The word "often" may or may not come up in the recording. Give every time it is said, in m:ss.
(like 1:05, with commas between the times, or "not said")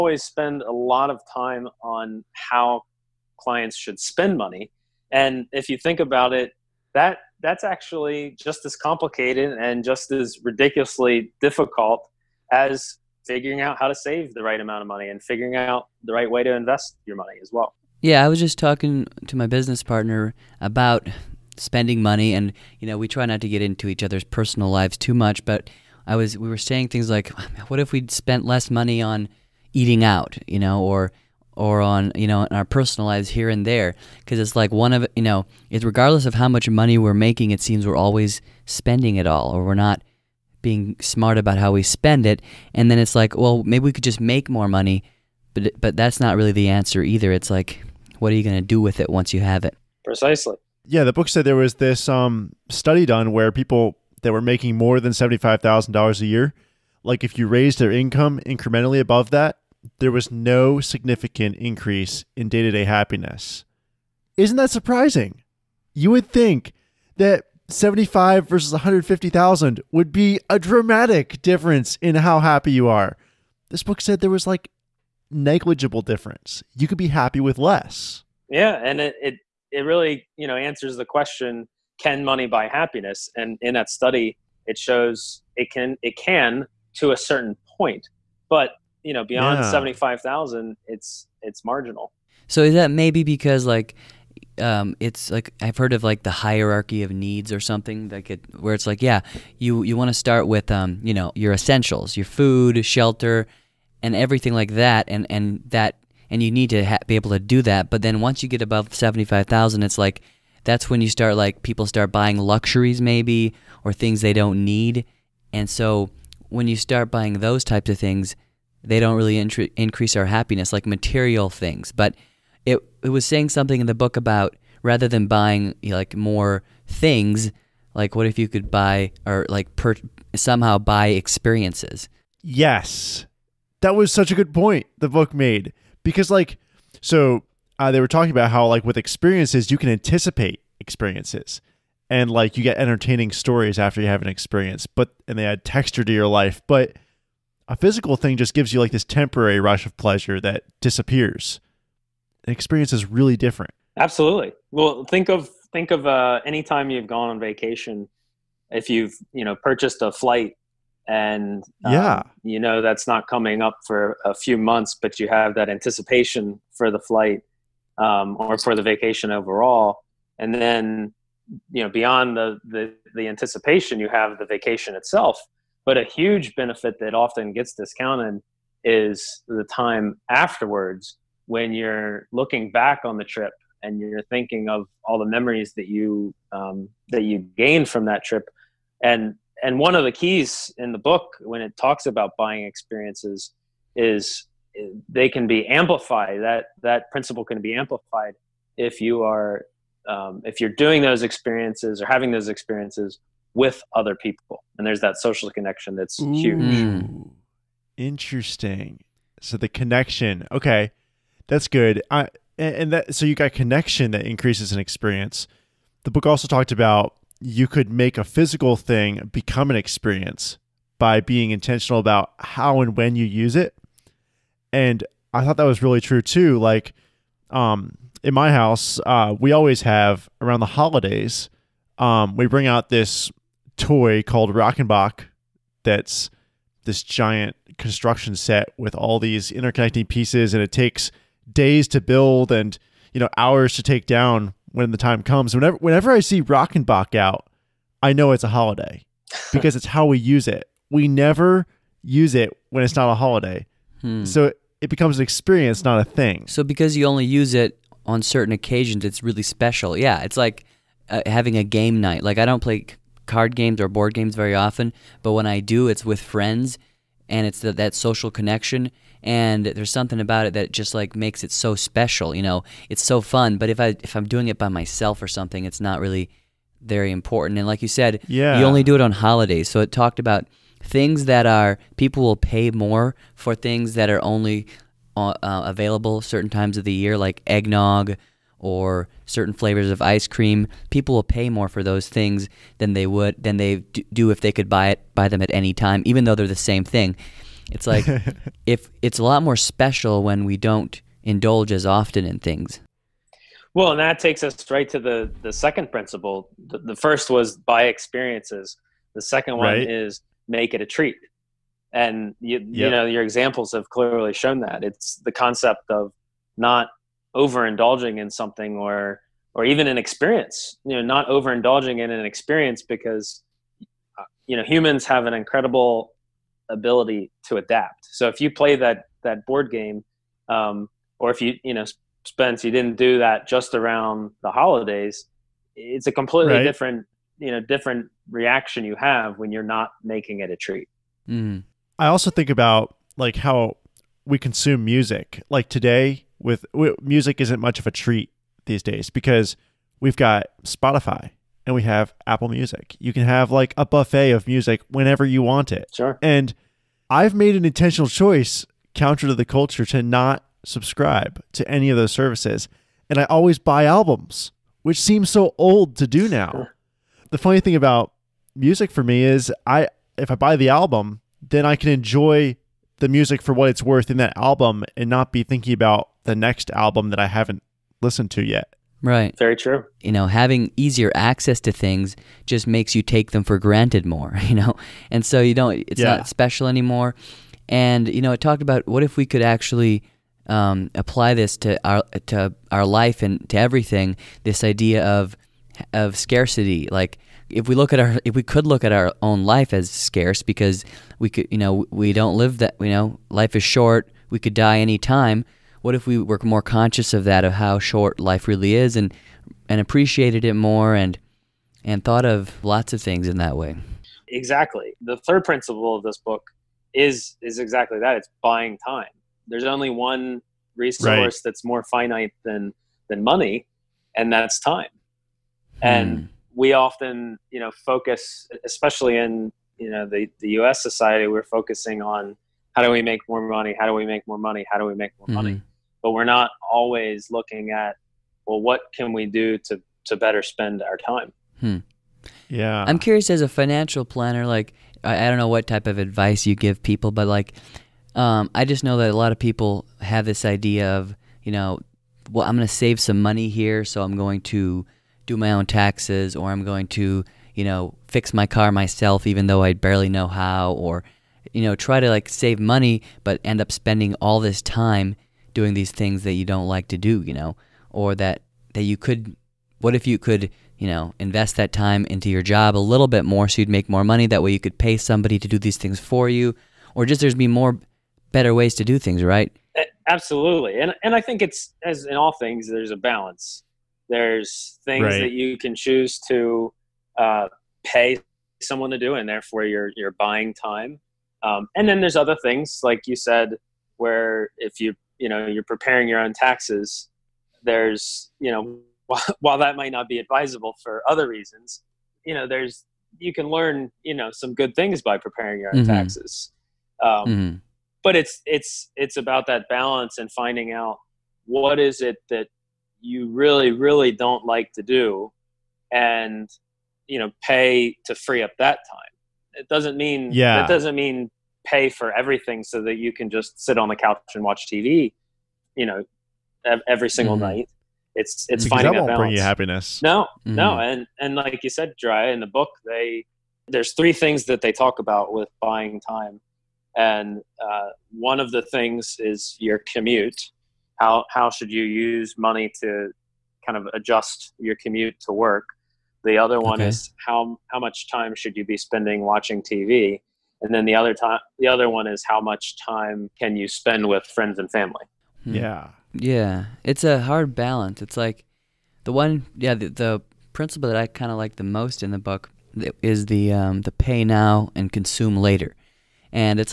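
2:57, 4:24, 5:01, 7:06.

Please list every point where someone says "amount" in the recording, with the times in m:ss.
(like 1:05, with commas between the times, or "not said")
0:14.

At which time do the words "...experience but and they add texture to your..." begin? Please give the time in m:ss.
2:24.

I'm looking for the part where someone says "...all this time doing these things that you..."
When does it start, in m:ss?
7:44.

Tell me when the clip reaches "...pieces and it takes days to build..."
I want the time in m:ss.
4:00.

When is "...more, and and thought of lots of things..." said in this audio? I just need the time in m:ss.
6:50.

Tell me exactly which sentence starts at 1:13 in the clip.
This book said there was like negligible difference.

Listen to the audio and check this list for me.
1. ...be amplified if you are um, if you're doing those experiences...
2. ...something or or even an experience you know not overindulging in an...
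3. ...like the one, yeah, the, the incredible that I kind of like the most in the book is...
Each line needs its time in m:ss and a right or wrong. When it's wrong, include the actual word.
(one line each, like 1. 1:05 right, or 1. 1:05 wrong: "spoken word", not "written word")
1. 3:17 right
2. 5:18 right
3. 9:18 wrong: "principle", not "incredible".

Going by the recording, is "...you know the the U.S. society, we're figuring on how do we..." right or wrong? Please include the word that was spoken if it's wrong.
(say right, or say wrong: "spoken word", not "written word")
wrong: "focusing", not "figuring".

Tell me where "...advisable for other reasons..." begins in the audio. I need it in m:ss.
8:20.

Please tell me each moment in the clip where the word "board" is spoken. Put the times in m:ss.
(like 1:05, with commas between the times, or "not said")
4:23, 5:29.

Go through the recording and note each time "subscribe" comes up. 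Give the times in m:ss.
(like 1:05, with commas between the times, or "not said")
6:00.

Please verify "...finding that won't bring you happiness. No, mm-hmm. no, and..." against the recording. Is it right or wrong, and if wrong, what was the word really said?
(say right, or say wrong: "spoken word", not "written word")
right.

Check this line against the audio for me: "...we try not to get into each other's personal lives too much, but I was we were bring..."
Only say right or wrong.
wrong.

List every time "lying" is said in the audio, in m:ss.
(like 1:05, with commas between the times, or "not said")
not said.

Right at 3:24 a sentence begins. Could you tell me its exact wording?
And there's that social connection that's Ooh, huge.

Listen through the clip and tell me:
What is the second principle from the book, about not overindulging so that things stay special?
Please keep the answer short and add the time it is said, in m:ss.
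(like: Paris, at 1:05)
Make it a treat, at 5:10.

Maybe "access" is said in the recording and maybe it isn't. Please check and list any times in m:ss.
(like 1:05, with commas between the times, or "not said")
6:21.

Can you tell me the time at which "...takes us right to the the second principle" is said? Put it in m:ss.
5:04.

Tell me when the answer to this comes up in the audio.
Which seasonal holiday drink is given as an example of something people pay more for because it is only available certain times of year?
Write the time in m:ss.
4:47.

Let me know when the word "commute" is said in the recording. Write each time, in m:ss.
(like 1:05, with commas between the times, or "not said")
8:59, 9:04.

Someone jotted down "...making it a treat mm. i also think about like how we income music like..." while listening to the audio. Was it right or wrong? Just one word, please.
wrong.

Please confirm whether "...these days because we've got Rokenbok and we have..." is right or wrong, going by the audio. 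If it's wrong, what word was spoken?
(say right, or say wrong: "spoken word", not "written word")
wrong: "Spotify", not "Rokenbok".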